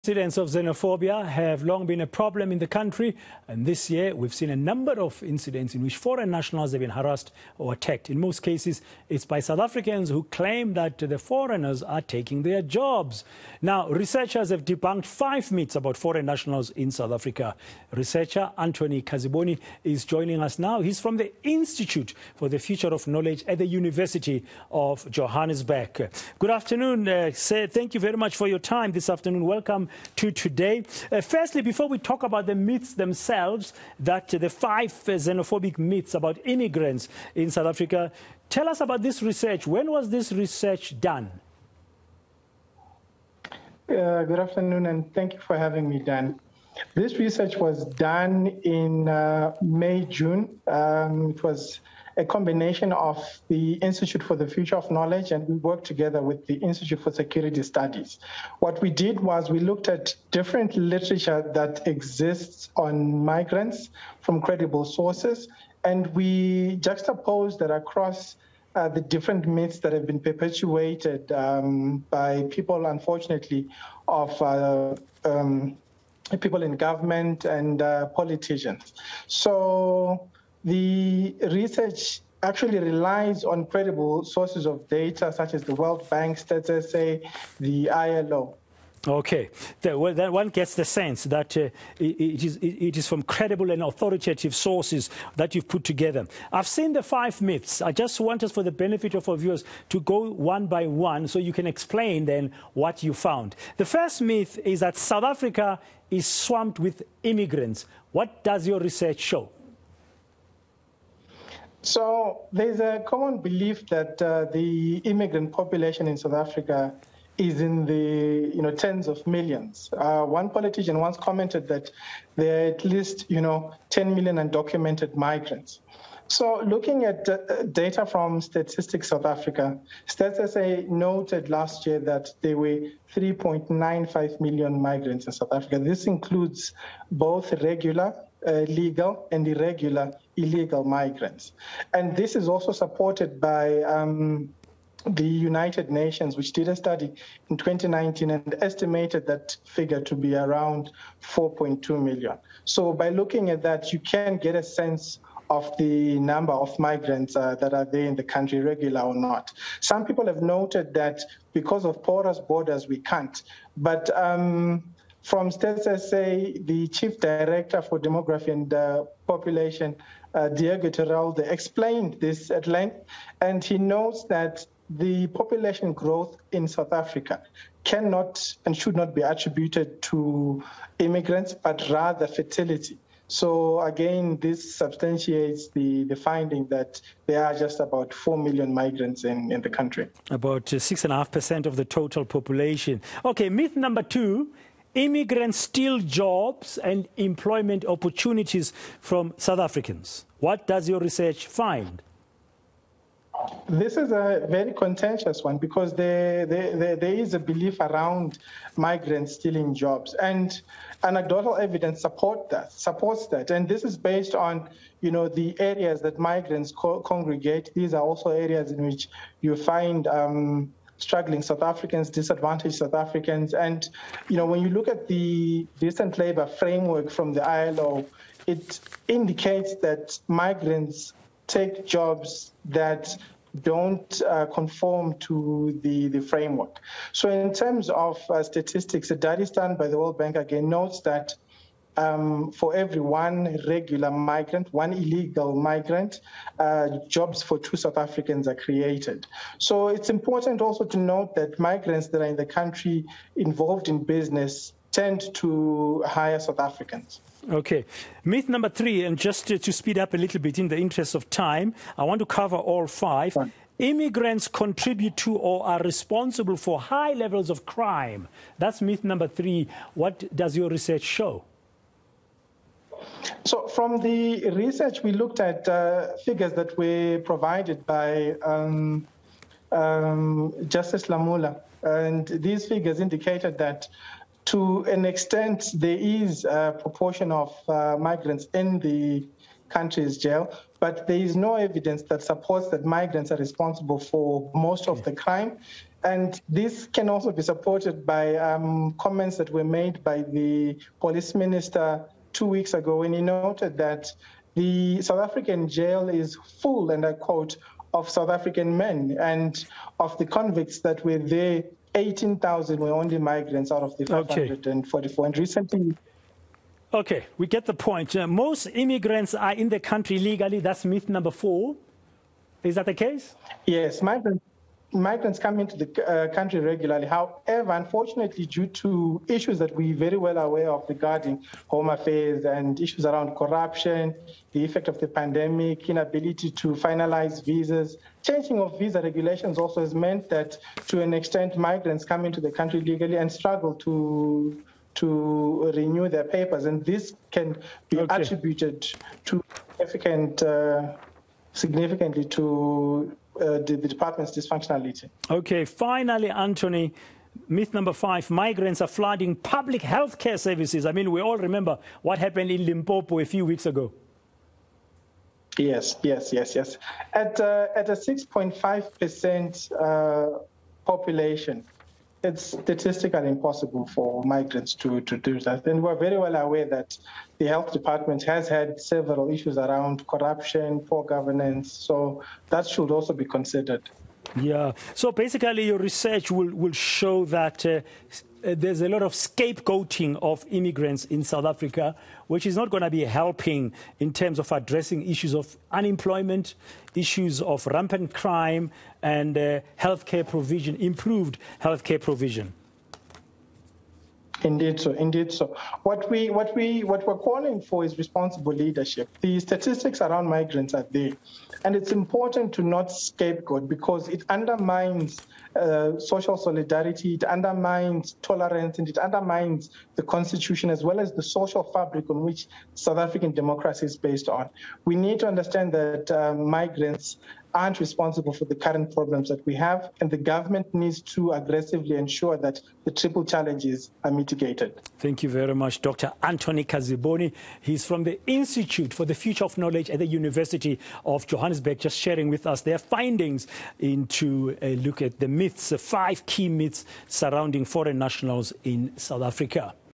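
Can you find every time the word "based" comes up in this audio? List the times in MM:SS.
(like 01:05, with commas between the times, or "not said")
03:33, 07:03.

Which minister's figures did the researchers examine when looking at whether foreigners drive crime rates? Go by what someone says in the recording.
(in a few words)
Justice Lamola.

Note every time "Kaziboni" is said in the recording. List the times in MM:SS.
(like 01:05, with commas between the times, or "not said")
00:19, 07:16.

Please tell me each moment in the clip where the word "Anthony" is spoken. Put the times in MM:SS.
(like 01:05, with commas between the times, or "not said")
00:18, 05:56, 07:16.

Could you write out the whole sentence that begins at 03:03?
So again, this substantiates the, the finding that there are just about 4 million migrants in, in the country.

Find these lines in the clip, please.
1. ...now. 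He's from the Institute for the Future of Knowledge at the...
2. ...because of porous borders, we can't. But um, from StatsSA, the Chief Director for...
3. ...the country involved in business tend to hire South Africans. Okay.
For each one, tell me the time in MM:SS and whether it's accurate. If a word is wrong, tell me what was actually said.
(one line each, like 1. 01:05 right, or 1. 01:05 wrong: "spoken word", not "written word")
1. 00:20 right
2. 02:41 right
3. 04:12 right.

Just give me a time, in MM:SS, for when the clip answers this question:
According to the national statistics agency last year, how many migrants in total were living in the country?
02:13.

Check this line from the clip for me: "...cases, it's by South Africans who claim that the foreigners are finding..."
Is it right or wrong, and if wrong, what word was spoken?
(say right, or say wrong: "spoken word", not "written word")
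wrong: "taking", not "finding".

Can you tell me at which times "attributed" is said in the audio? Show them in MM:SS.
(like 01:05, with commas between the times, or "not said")
02:59, 05:48.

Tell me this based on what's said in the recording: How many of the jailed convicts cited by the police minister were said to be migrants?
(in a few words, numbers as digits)
18,000.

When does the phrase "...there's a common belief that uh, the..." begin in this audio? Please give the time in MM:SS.
01:52.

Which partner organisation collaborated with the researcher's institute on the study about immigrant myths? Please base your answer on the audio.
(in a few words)
Institute for Security Studies.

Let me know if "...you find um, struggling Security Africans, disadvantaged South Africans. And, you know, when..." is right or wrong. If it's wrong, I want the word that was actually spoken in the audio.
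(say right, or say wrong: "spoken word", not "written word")
wrong: "South", not "Security".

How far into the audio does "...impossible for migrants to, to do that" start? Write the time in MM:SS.
06:13.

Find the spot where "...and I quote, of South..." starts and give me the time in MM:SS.
05:06.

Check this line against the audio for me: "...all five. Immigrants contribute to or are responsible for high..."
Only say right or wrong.
right.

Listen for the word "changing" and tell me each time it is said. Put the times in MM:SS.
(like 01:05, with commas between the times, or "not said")
05:38.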